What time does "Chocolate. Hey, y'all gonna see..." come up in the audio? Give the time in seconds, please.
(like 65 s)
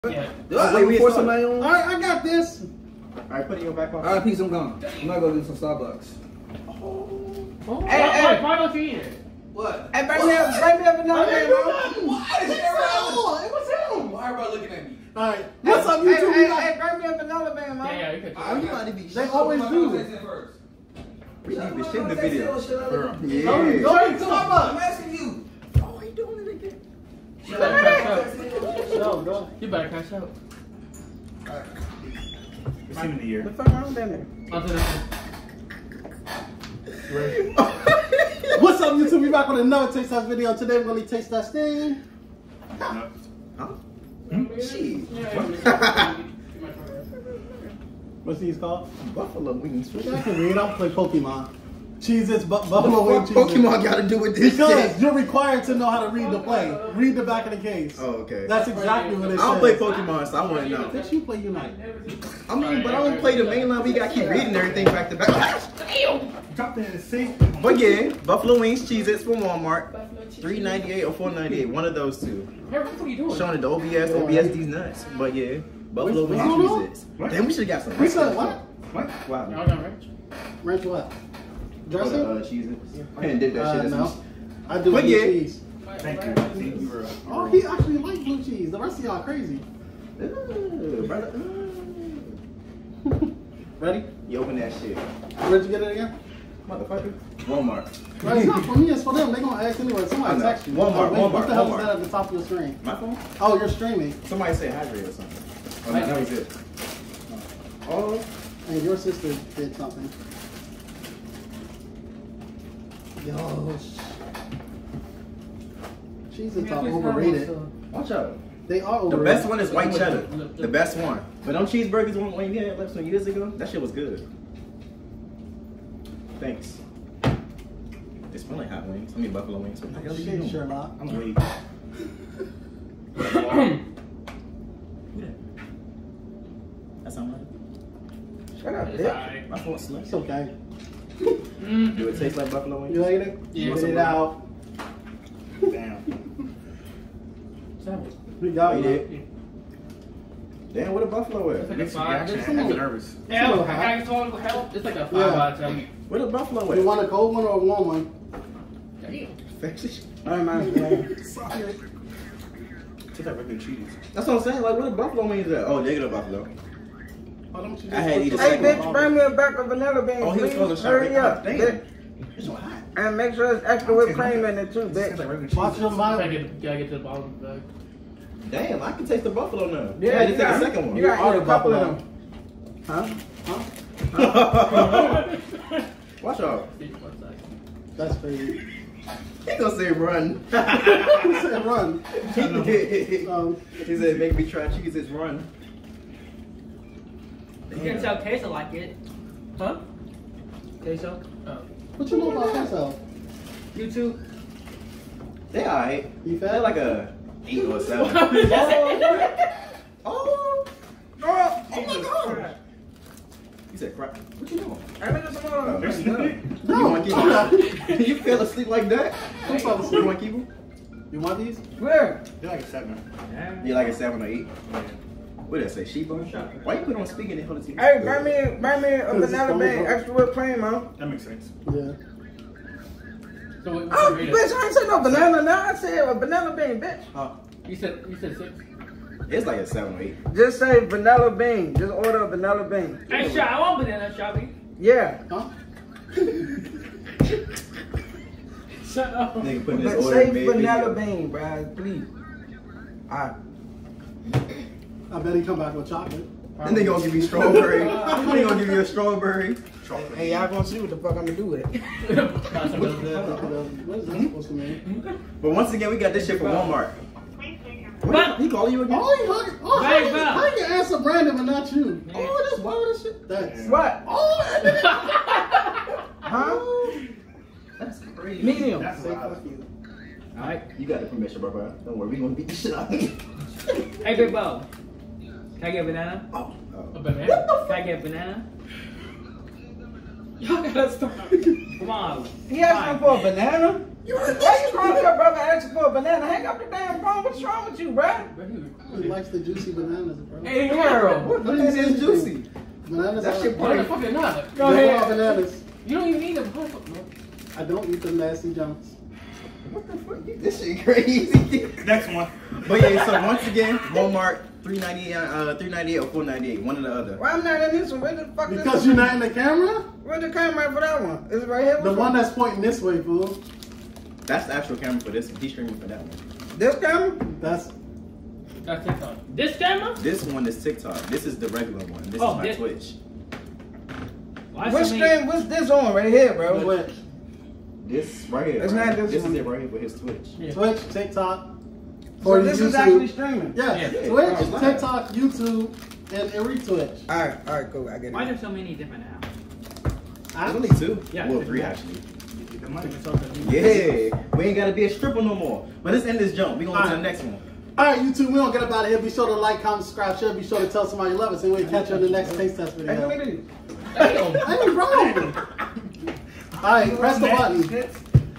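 259 s.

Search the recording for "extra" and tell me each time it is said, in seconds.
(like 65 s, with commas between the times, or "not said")
173 s, 229 s.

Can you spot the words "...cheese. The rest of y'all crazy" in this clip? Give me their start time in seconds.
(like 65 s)
88 s.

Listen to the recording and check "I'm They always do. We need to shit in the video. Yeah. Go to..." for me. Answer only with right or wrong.
right.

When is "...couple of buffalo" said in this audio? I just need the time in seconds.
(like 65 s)
181 s.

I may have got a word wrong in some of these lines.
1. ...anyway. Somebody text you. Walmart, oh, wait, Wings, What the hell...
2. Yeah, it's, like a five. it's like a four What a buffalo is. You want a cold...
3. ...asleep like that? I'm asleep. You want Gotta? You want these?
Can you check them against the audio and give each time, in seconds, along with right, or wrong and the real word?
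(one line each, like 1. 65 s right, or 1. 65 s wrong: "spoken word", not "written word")
1. 99 s wrong: "Walmart", not "Wings"
2. 153 s wrong: "five", not "four"
3. 218 s wrong: "Kibu", not "Gotta".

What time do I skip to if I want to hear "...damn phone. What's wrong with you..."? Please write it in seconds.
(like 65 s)
296 s.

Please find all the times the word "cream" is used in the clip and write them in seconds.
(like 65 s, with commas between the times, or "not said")
174 s, 230 s.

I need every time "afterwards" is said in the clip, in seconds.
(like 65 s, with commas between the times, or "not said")
not said.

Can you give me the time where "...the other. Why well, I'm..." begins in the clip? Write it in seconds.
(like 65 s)
316 s.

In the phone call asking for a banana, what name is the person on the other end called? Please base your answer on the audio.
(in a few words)
Big Bo.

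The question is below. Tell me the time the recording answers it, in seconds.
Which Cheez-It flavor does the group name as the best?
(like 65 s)
119 s.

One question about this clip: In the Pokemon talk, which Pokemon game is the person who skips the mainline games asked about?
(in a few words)
Unite.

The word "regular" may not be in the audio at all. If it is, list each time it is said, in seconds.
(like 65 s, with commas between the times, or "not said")
163 s, 331 s.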